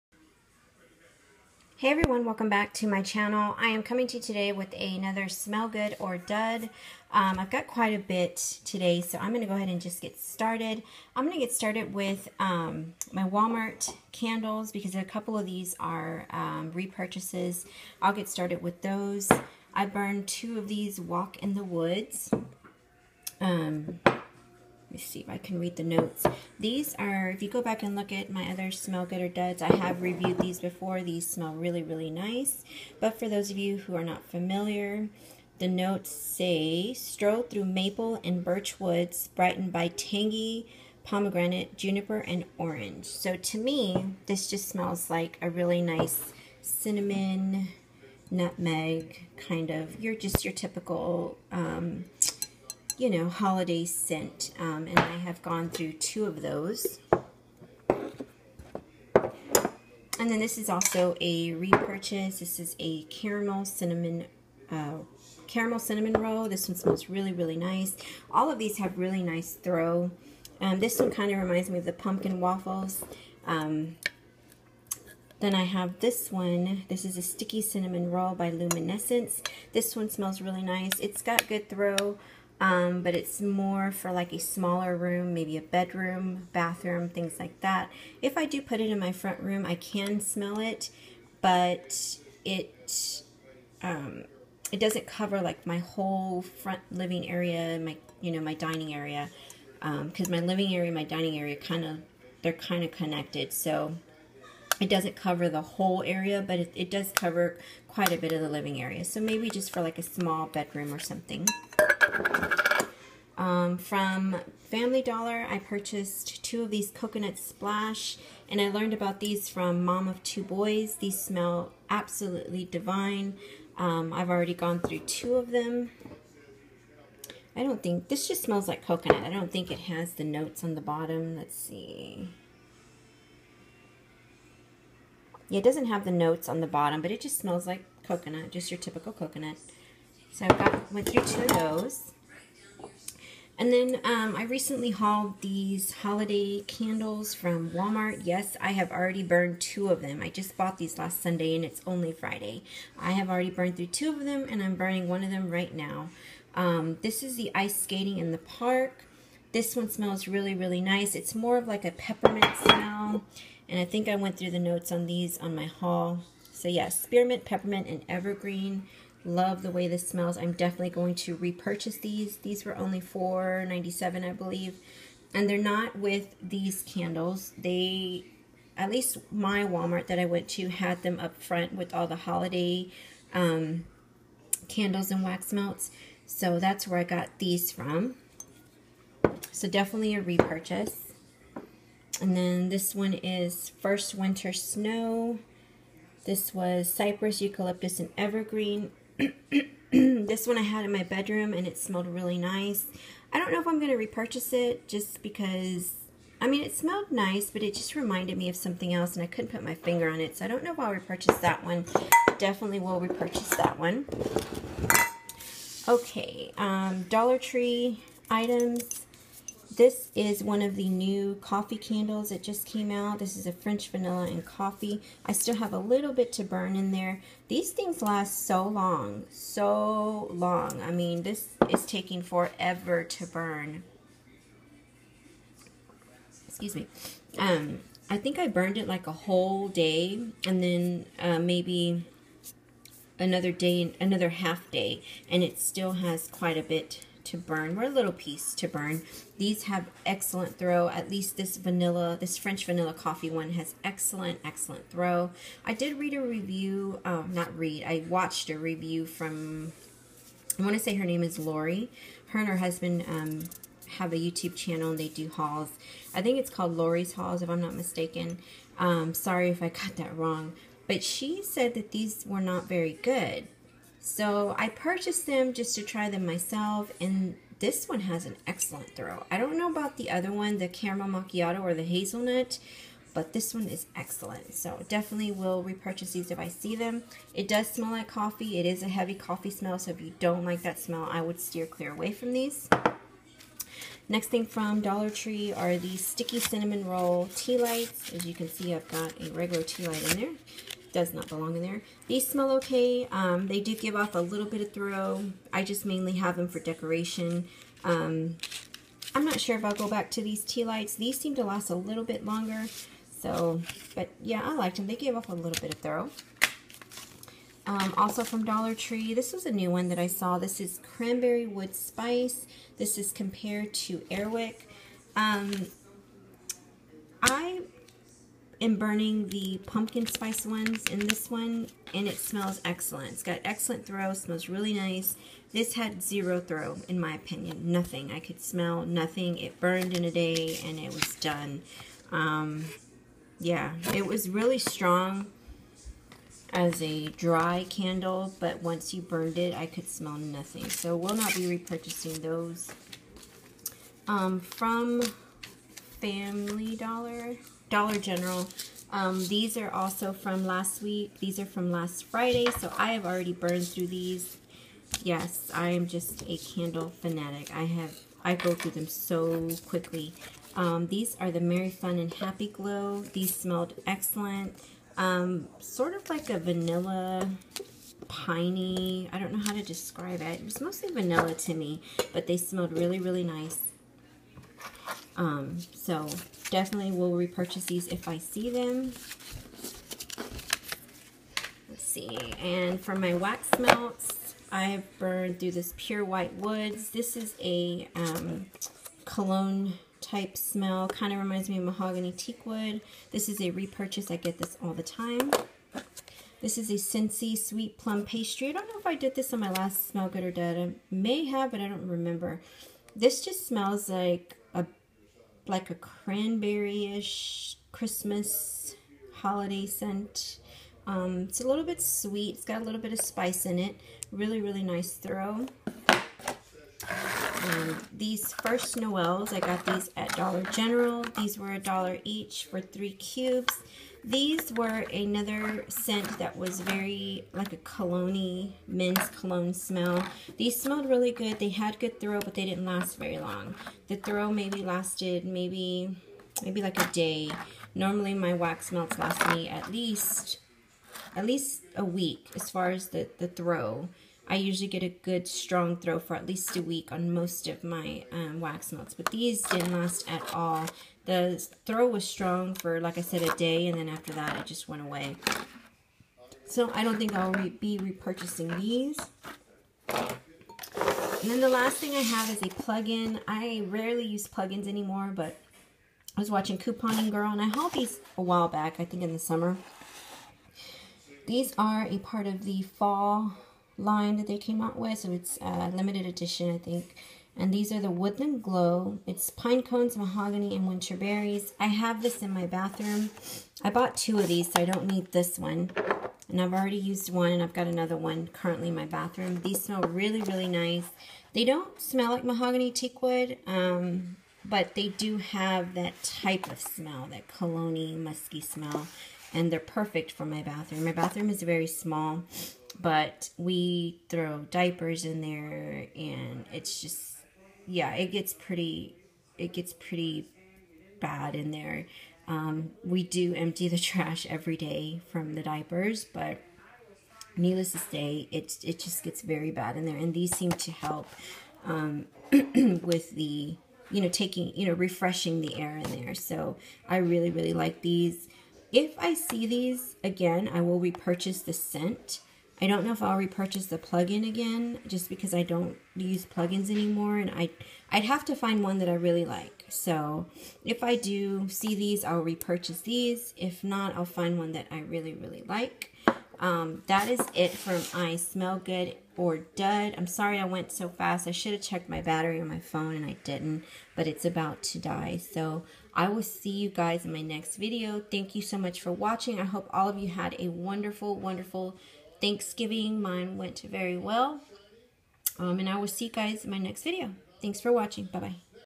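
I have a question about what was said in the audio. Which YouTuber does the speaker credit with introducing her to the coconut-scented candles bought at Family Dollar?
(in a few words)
Mom of Two Boys.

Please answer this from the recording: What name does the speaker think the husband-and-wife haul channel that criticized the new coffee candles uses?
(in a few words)
Lori's Hauls.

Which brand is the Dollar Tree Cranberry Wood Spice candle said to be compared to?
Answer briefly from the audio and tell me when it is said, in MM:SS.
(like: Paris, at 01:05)
Airwick, at 05:24.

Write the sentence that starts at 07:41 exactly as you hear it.
The throw was strong for, like I said, a day, and then after that it just went away.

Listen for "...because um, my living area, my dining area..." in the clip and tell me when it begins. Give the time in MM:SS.
01:40.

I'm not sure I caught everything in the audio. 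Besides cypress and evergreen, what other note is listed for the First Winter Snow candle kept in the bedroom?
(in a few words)
Eucalyptus.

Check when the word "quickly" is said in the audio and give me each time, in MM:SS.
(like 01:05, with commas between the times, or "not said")
06:09.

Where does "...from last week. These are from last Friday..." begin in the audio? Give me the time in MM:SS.
06:00.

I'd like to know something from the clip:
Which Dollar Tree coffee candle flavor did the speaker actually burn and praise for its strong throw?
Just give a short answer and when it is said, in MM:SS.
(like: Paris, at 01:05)
French vanilla and coffee, at 03:43.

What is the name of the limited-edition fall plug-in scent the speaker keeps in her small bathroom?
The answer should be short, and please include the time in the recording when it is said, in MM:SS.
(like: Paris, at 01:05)
Woodland Glow, at 08:07.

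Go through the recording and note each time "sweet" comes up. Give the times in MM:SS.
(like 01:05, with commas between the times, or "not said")
06:47, 07:01.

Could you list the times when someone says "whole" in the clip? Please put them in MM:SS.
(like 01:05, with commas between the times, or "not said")
01:35, 01:45, 03:59.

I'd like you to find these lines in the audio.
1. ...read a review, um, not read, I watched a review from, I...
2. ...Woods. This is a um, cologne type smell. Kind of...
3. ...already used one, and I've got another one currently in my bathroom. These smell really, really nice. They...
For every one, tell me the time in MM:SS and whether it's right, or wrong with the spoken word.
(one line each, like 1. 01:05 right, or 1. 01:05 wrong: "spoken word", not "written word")
1. 04:15 right
2. 06:36 right
3. 08:16 right.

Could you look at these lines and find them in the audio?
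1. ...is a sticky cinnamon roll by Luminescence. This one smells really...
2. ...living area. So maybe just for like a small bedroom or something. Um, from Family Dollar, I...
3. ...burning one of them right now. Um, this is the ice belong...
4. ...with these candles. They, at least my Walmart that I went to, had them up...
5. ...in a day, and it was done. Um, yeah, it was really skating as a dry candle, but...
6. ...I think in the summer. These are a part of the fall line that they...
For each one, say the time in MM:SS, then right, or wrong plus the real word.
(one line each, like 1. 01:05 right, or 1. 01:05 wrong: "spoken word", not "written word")
1. 01:17 right
2. 01:48 right
3. 02:34 wrong: "skating", not "belong"
4. 02:55 right
5. 05:39 wrong: "strong", not "skating"
6. 07:58 right.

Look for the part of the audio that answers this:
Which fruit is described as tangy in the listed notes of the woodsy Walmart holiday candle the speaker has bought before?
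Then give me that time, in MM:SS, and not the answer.
00:41.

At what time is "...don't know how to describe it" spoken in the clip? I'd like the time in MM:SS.
06:19.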